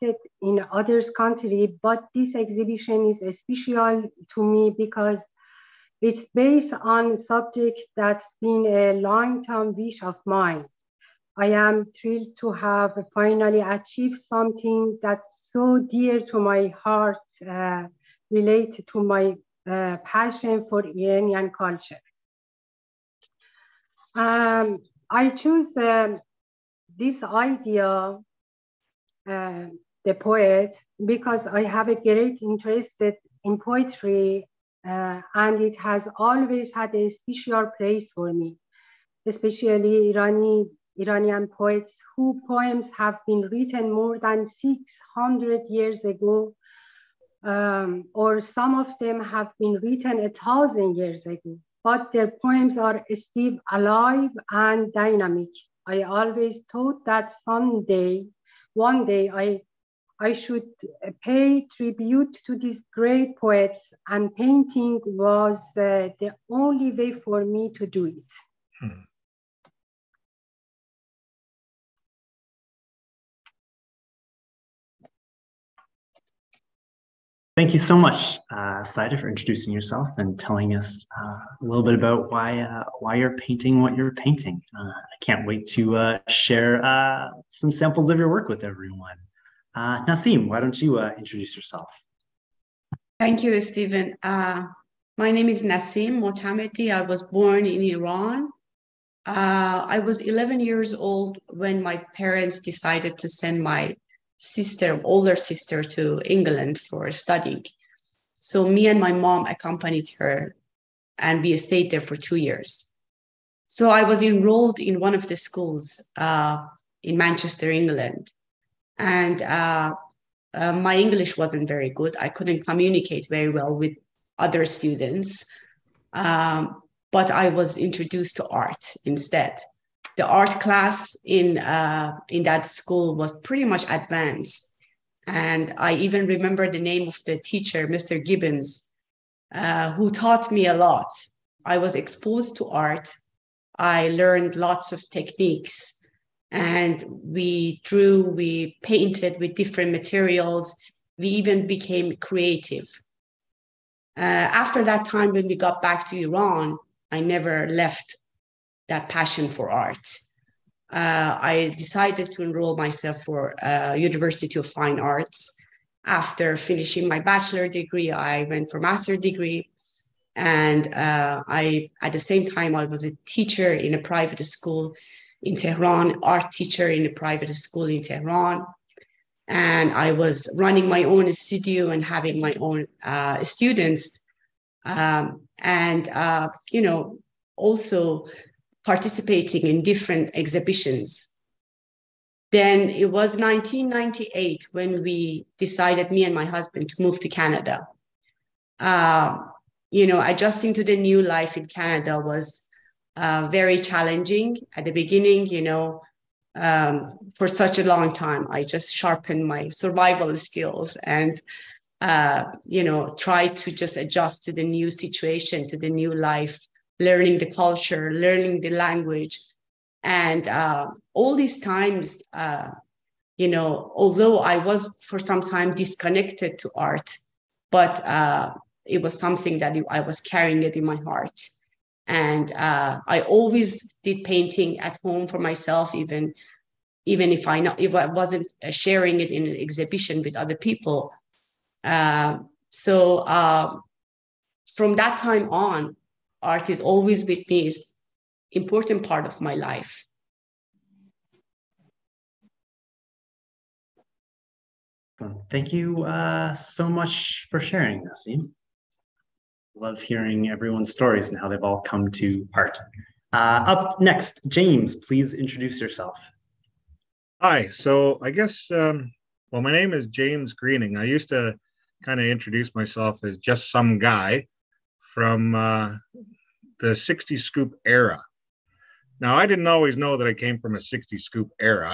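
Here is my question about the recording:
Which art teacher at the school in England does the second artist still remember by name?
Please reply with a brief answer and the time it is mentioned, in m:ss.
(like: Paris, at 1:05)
Mr. Gibbons, at 2:17.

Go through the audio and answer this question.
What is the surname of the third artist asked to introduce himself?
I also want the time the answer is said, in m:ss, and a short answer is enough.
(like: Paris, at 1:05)
Groening, at 4:30.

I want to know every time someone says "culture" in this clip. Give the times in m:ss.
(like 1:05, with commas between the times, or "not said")
0:21, 3:37.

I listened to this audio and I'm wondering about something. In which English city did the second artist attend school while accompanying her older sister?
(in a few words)
Manchester.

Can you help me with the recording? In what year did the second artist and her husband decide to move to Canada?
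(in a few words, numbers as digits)
1998.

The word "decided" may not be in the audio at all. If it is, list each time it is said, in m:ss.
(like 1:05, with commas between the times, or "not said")
1:42, 2:41, 3:15.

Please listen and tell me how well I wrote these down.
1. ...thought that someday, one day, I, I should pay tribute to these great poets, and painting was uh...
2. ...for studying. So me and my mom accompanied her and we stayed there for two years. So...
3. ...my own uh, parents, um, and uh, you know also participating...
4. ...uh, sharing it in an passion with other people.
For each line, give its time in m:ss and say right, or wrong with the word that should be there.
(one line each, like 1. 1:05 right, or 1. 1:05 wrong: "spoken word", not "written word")
1. 0:56 right
2. 1:46 right
3. 3:02 wrong: "students", not "parents"
4. 3:58 wrong: "exhibition", not "passion".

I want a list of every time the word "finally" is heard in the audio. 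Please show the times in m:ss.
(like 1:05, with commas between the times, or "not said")
0:13.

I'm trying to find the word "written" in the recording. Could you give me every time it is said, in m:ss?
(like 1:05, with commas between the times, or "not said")
0:43, 0:49.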